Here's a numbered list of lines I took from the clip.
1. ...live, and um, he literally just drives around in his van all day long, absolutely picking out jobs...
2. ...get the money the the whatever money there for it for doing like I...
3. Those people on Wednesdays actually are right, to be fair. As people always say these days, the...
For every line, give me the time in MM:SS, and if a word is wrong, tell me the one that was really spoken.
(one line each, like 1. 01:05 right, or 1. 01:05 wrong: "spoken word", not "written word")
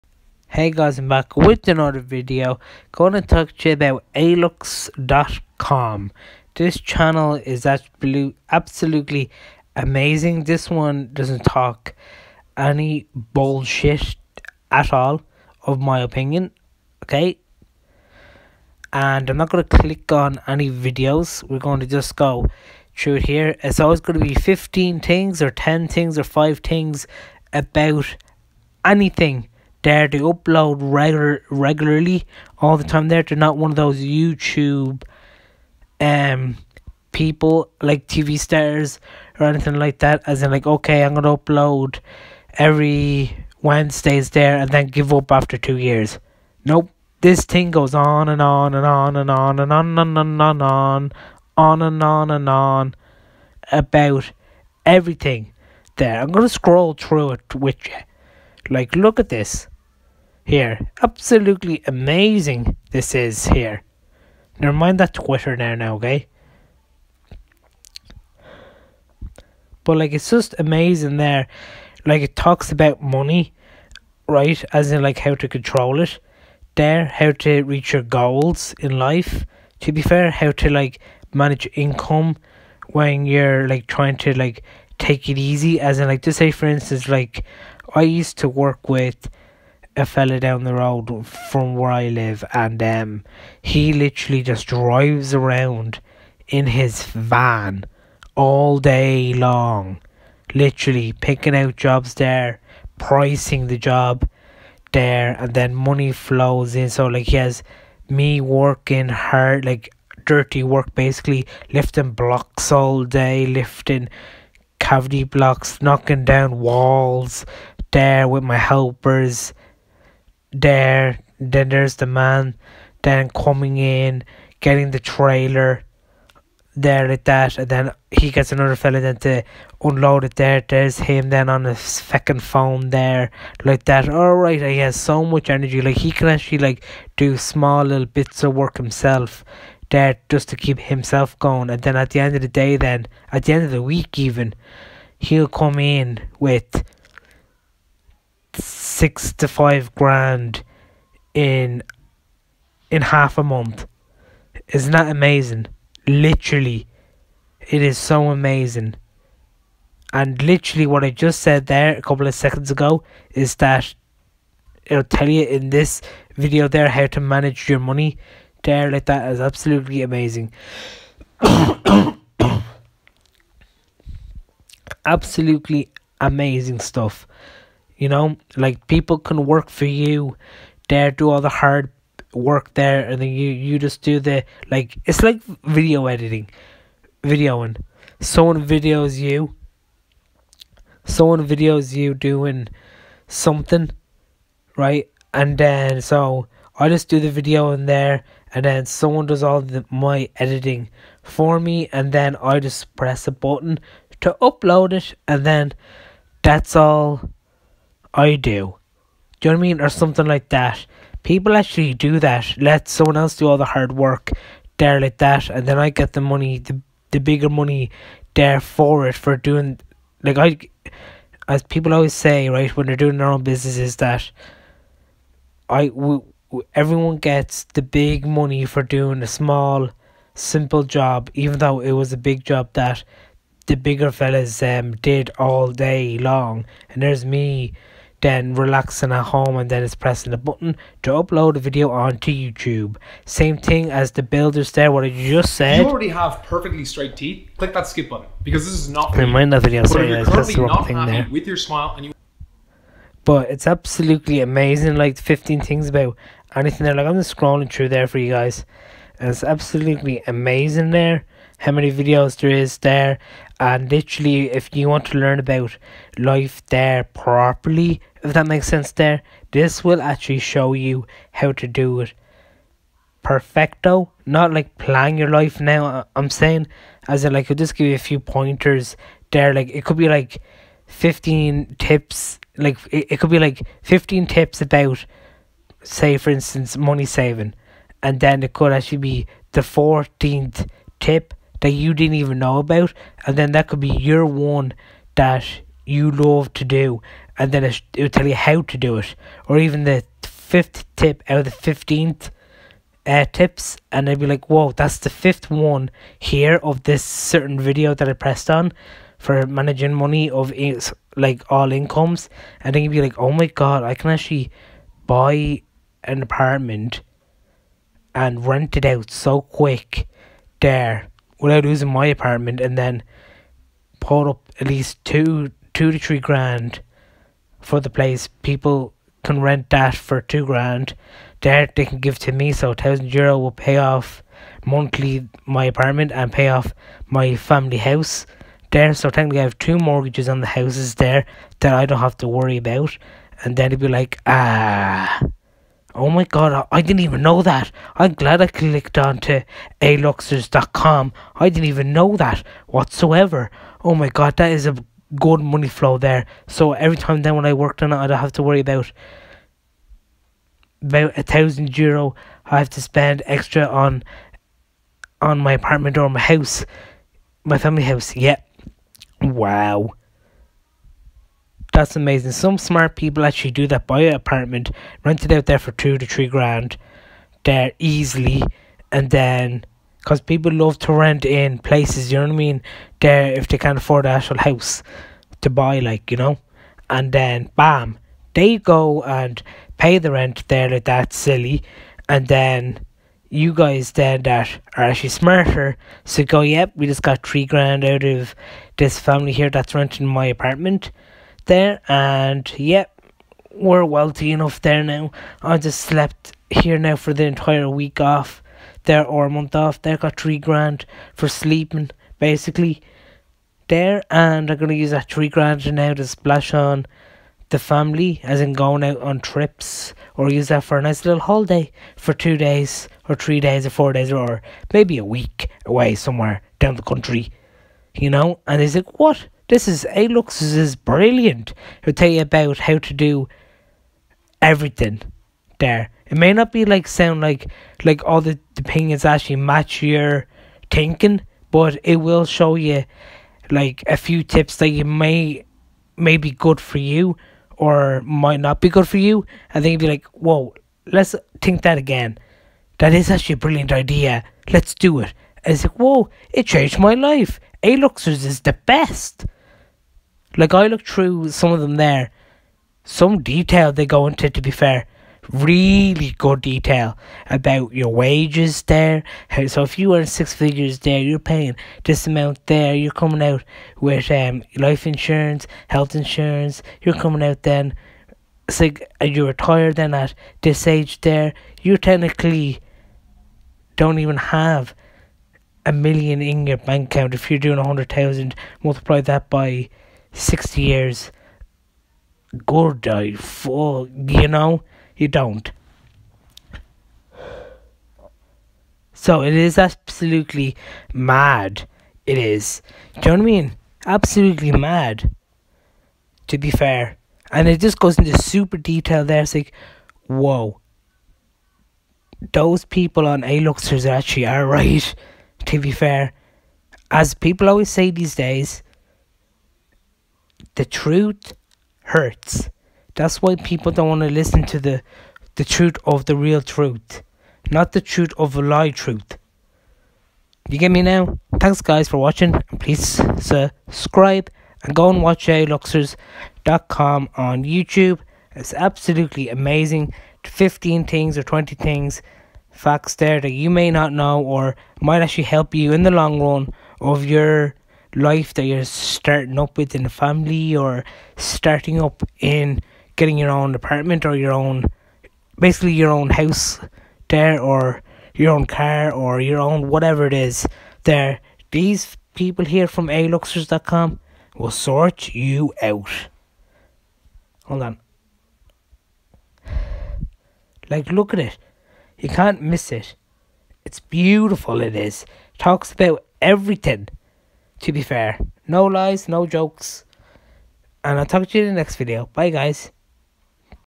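1. 01:32 wrong: "literally", not "absolutely"
2. 03:35 wrong: "bigger", not "whatever"
3. 08:32 wrong: "Aluxers", not "Wednesdays".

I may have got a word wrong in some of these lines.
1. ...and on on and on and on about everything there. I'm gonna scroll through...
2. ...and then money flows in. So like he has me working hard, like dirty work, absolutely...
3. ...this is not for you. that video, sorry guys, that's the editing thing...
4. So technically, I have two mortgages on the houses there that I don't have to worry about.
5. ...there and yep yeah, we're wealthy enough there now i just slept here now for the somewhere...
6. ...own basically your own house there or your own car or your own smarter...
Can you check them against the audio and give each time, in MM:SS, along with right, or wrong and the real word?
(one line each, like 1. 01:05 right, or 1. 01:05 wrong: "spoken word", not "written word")
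1. 00:50 right
2. 01:45 wrong: "basically", not "absolutely"
3. 04:08 wrong: "wrong", not "editing"
4. 05:38 right
5. 06:41 wrong: "entire", not "somewhere"
6. 09:14 wrong: "whatever", not "smarter".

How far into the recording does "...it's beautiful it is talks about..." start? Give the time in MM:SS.
09:33.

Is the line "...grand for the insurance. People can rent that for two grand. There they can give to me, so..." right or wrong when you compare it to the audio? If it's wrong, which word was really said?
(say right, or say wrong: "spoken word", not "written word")
wrong: "place", not "insurance".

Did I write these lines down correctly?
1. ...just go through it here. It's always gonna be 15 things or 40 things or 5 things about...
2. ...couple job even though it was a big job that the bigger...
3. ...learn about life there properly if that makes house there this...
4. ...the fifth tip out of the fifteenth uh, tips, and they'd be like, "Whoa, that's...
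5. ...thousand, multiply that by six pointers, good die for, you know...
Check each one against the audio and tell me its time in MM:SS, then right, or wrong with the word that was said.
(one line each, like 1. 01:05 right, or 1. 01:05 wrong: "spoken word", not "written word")
1. 00:21 wrong: "10", not "40"
2. 03:50 wrong: "simple", not "couple"
3. 04:25 wrong: "sense", not "house"
4. 04:59 right
5. 08:07 wrong: "years", not "pointers".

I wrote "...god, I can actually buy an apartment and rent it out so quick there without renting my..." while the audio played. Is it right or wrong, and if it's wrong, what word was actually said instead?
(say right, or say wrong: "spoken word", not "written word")
wrong: "losing", not "renting".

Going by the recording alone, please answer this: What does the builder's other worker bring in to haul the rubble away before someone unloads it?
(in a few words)
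trailer.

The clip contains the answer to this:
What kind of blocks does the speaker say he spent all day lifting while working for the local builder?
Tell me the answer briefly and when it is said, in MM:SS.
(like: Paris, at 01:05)
cavity blocks, at 01:54.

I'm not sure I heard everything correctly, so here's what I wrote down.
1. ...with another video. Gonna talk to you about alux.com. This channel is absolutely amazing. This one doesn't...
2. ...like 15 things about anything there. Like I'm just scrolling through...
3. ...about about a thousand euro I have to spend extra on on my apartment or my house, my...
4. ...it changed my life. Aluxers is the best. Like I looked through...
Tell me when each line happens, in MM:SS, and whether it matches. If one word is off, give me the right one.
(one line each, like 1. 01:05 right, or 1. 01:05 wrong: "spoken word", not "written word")
1. 00:01 right
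2. 04:14 right
3. 05:58 right
4. 07:36 right.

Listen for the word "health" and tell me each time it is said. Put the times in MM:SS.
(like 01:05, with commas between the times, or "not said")
07:55.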